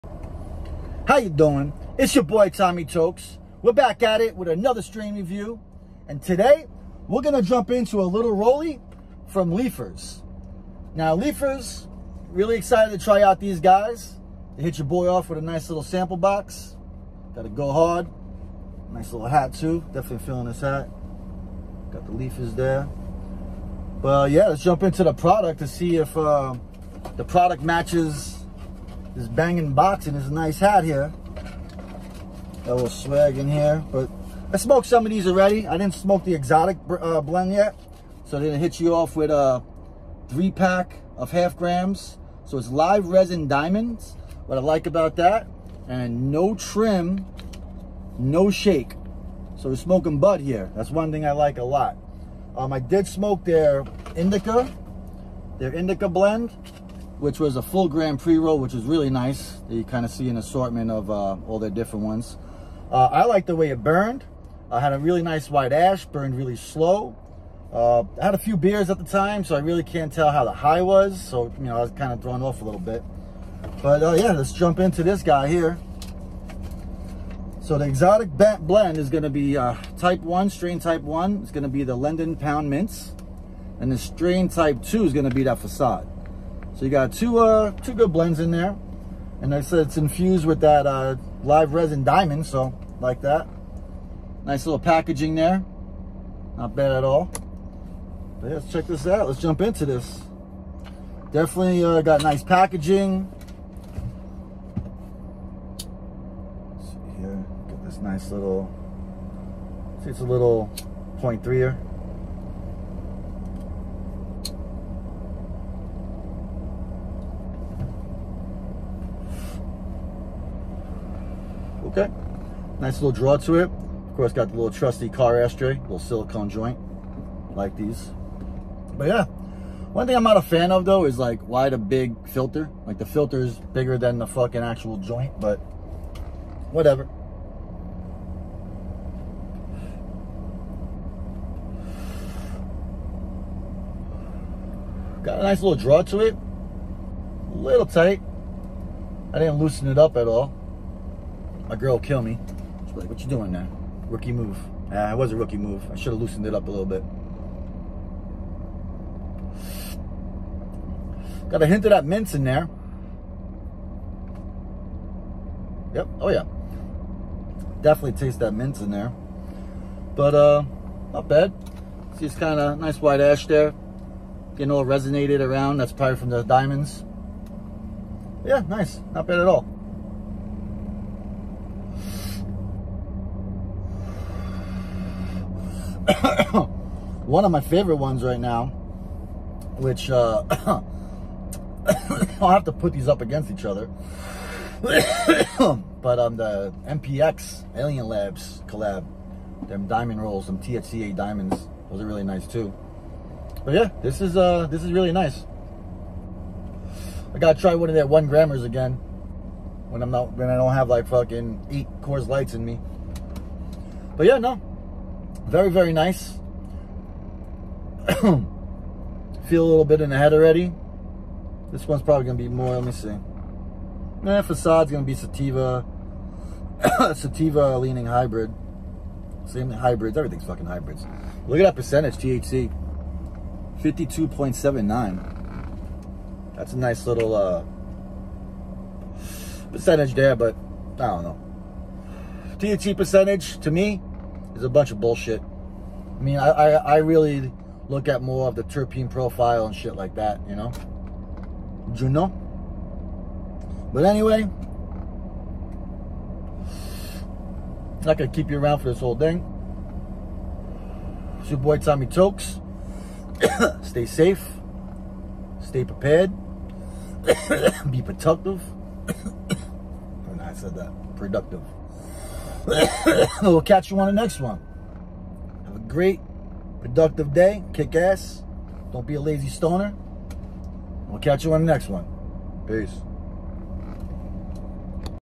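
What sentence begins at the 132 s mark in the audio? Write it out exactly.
Like the filter is bigger than the fucking actual joint, but whatever.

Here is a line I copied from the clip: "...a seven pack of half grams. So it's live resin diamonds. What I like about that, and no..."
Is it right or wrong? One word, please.
wrong.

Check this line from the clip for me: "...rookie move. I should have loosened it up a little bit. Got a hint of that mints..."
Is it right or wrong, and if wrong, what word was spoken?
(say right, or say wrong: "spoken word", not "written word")
right.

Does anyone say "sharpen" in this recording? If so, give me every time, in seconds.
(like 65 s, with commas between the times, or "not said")
not said.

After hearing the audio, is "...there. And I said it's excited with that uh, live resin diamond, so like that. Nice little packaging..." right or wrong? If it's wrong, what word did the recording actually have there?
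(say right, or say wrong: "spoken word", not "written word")
wrong: "infused", not "excited".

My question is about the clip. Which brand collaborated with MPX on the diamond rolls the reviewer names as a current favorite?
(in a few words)
Alien Labs.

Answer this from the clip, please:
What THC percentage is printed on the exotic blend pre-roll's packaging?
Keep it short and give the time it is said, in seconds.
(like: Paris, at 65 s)
52.79, at 233 s.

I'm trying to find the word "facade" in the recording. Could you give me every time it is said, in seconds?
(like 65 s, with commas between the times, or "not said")
85 s, 224 s.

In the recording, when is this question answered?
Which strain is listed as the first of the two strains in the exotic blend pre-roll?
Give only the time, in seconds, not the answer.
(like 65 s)
81 s.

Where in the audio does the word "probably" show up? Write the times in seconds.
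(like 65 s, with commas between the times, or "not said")
175 s, 222 s.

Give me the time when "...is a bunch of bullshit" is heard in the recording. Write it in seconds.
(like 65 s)
244 s.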